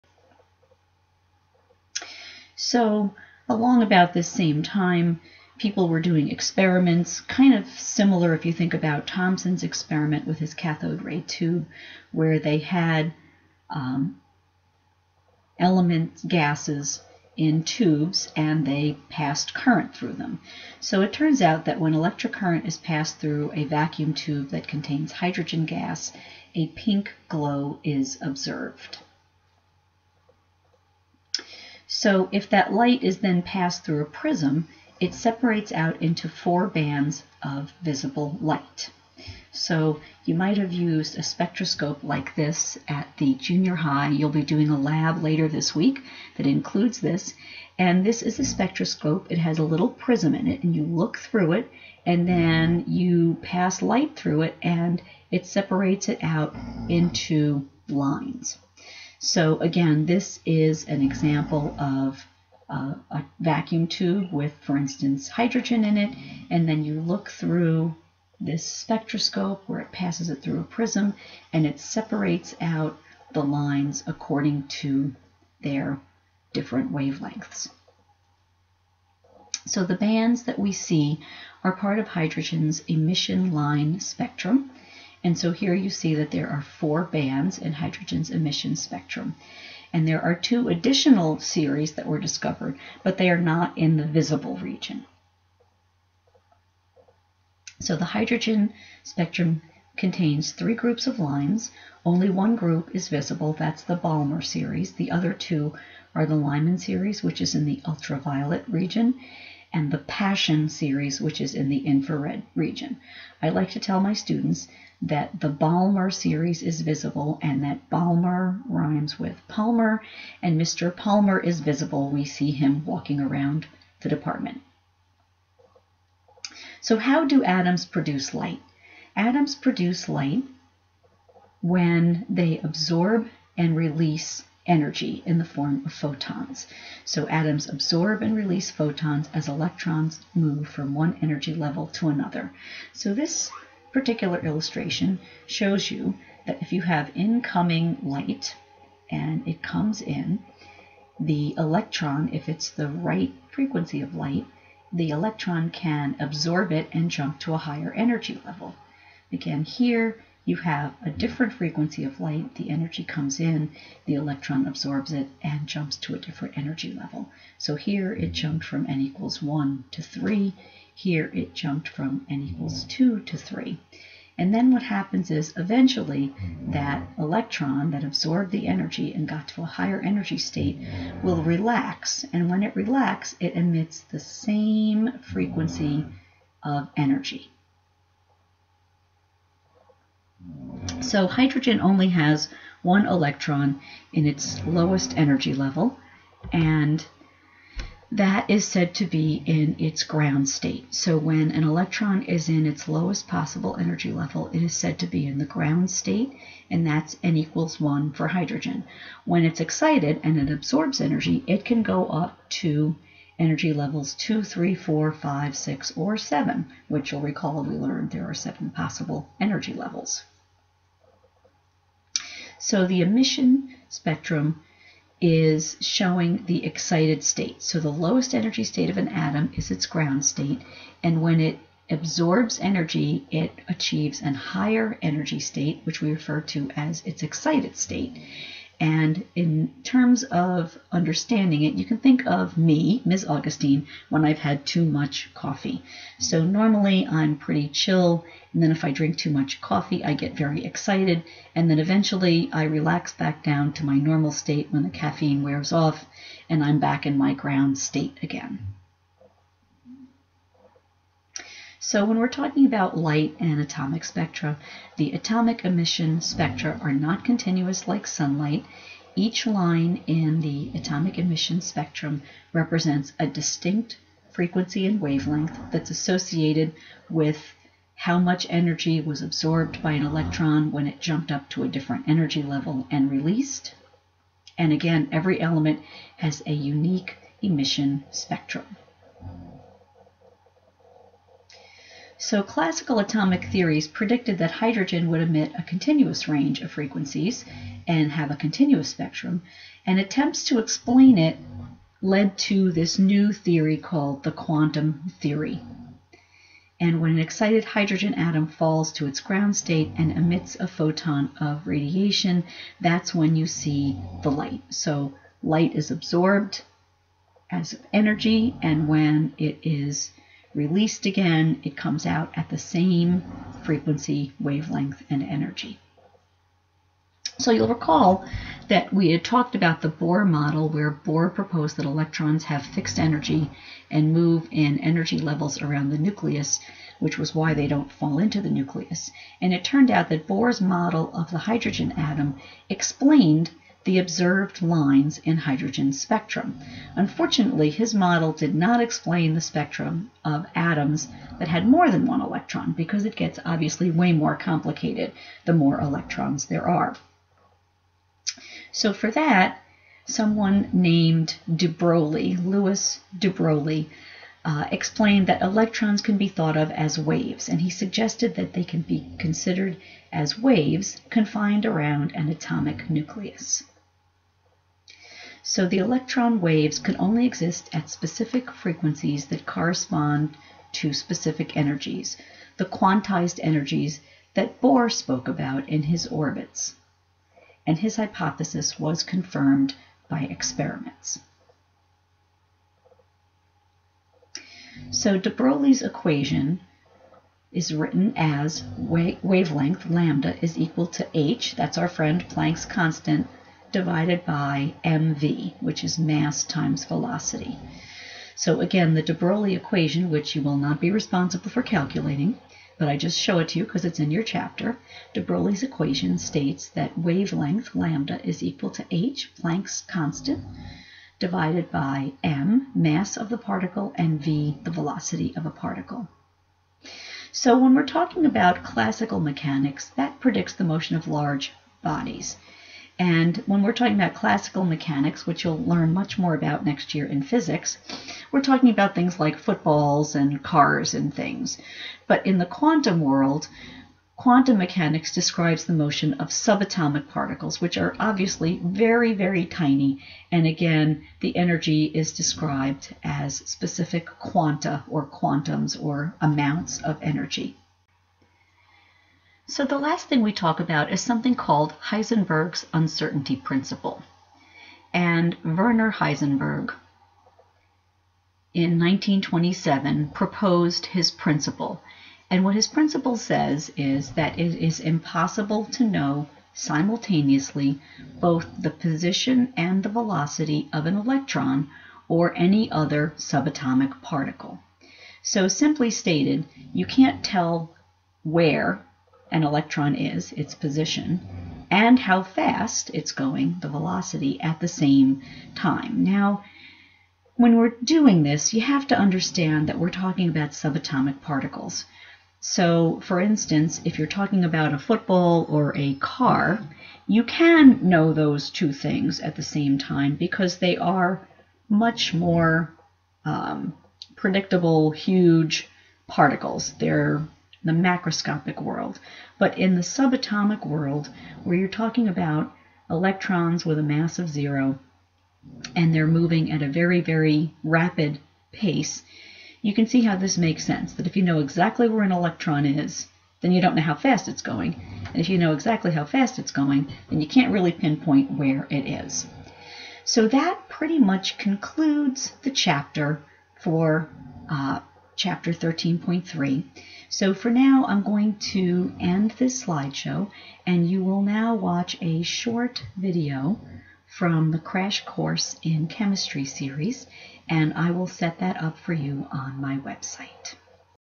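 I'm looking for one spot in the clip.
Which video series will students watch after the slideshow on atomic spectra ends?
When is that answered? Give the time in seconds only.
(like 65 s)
554 s.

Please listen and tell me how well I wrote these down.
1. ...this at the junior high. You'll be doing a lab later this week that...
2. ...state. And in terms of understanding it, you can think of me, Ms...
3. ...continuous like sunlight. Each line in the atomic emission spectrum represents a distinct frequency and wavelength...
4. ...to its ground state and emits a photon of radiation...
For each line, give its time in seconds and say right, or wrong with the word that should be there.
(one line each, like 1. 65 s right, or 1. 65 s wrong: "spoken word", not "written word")
1. 42 s right
2. 237 s right
3. 267 s right
4. 308 s right.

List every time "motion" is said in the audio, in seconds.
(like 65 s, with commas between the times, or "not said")
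430 s, 445 s.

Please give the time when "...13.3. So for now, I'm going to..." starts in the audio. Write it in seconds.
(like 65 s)
545 s.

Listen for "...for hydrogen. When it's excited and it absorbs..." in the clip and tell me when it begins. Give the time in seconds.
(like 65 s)
208 s.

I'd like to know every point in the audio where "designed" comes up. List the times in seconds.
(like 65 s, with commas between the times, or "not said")
not said.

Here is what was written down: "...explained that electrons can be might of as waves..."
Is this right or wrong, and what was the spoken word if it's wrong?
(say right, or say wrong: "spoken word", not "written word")
wrong: "thought", not "might".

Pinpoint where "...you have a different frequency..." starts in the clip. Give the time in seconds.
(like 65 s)
160 s.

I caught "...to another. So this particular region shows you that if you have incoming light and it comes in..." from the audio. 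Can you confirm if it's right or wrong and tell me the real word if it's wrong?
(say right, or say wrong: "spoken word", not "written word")
wrong: "illustration", not "region".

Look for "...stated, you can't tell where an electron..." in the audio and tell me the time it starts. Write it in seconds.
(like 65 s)
485 s.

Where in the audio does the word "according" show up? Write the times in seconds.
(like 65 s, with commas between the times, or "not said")
74 s.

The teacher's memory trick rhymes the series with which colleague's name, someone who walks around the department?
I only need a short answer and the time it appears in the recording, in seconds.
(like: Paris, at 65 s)
Mr. Palmer, at 120 s.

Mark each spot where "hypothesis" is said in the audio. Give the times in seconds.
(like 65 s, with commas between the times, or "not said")
387 s.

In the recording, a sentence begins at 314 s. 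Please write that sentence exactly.
So light is absorbed as energy, and when it is released again, it comes out at the same frequency, wavelength, and energy.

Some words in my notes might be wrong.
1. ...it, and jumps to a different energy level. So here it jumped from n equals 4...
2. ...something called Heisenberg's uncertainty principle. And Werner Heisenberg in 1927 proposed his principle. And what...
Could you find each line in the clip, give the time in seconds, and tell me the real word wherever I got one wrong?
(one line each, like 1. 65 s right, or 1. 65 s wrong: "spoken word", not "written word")
1. 165 s wrong: "1", not "4"
2. 461 s right.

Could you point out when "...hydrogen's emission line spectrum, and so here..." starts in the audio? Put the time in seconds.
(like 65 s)
82 s.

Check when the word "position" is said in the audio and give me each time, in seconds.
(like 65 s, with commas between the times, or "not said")
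478 s, 490 s.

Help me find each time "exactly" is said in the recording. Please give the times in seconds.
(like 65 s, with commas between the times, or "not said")
531 s, 535 s.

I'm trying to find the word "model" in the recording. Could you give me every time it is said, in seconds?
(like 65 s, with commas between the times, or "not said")
330 s, 340 s, 347 s.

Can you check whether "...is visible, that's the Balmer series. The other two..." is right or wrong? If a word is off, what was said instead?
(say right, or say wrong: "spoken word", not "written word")
right.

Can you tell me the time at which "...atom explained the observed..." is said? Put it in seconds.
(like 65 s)
341 s.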